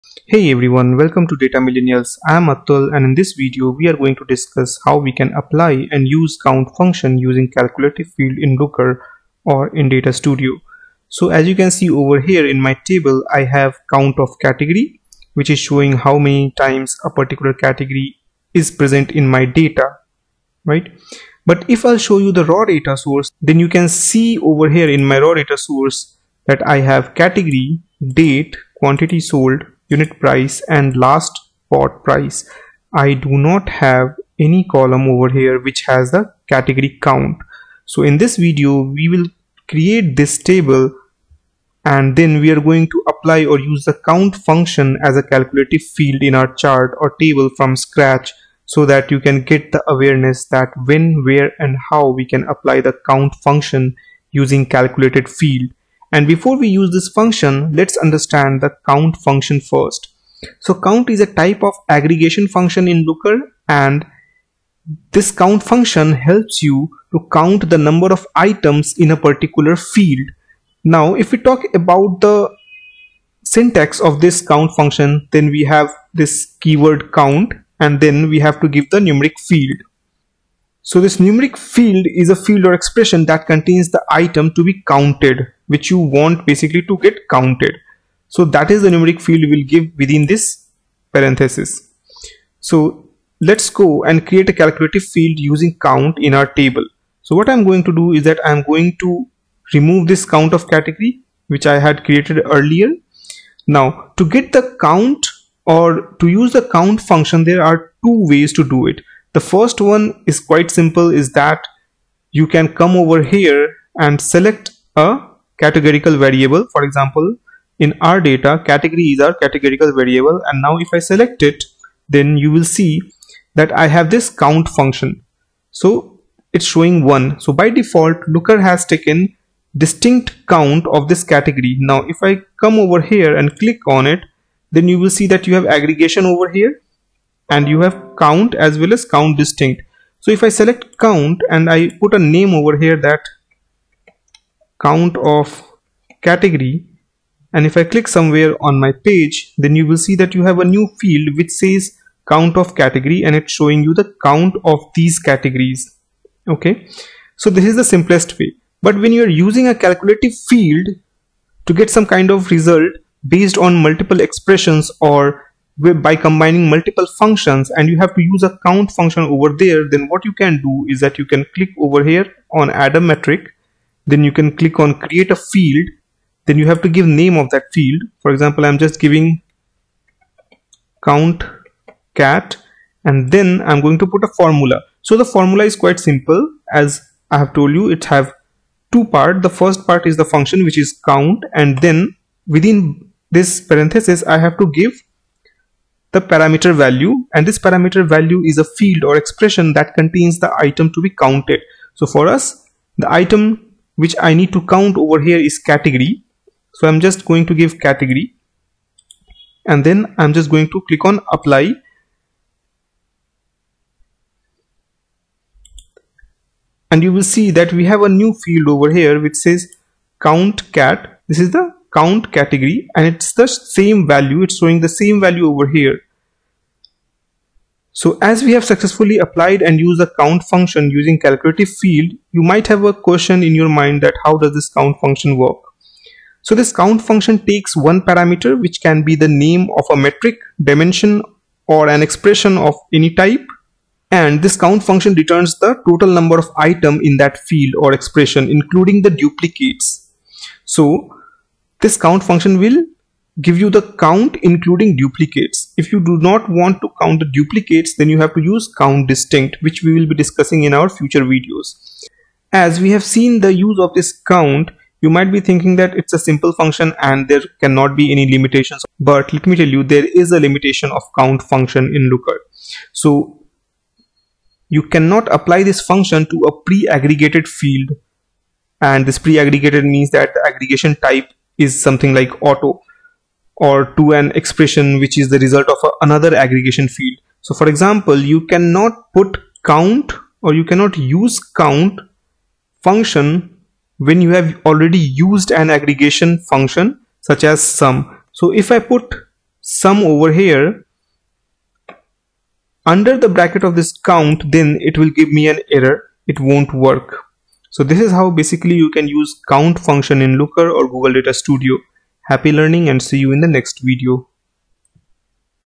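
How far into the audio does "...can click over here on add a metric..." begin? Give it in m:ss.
2:51.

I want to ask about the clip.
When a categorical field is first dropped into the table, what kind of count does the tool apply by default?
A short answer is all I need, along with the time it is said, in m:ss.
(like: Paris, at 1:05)
distinct count, at 2:09.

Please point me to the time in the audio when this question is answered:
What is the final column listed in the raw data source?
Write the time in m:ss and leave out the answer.
0:31.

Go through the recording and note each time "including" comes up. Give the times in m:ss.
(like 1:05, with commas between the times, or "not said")
4:08, 4:14.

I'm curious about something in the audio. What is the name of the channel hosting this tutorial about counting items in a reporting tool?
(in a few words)
Data Millennials.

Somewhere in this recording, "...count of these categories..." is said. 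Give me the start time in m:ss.
2:34.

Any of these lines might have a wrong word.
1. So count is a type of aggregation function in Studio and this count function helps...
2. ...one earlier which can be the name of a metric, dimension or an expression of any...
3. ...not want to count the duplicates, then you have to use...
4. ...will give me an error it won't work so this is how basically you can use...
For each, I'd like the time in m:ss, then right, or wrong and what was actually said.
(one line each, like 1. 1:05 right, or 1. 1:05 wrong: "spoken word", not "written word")
1. 1:00 wrong: "Looker", not "Studio"
2. 3:57 wrong: "parameter", not "earlier"
3. 4:16 right
4. 5:04 right.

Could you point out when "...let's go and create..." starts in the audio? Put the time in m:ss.
1:33.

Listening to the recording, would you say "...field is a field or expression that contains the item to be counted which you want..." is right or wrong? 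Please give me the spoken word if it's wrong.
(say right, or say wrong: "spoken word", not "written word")
right.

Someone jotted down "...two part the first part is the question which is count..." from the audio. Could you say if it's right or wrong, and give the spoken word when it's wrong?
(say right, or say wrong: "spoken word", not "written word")
wrong: "function", not "question".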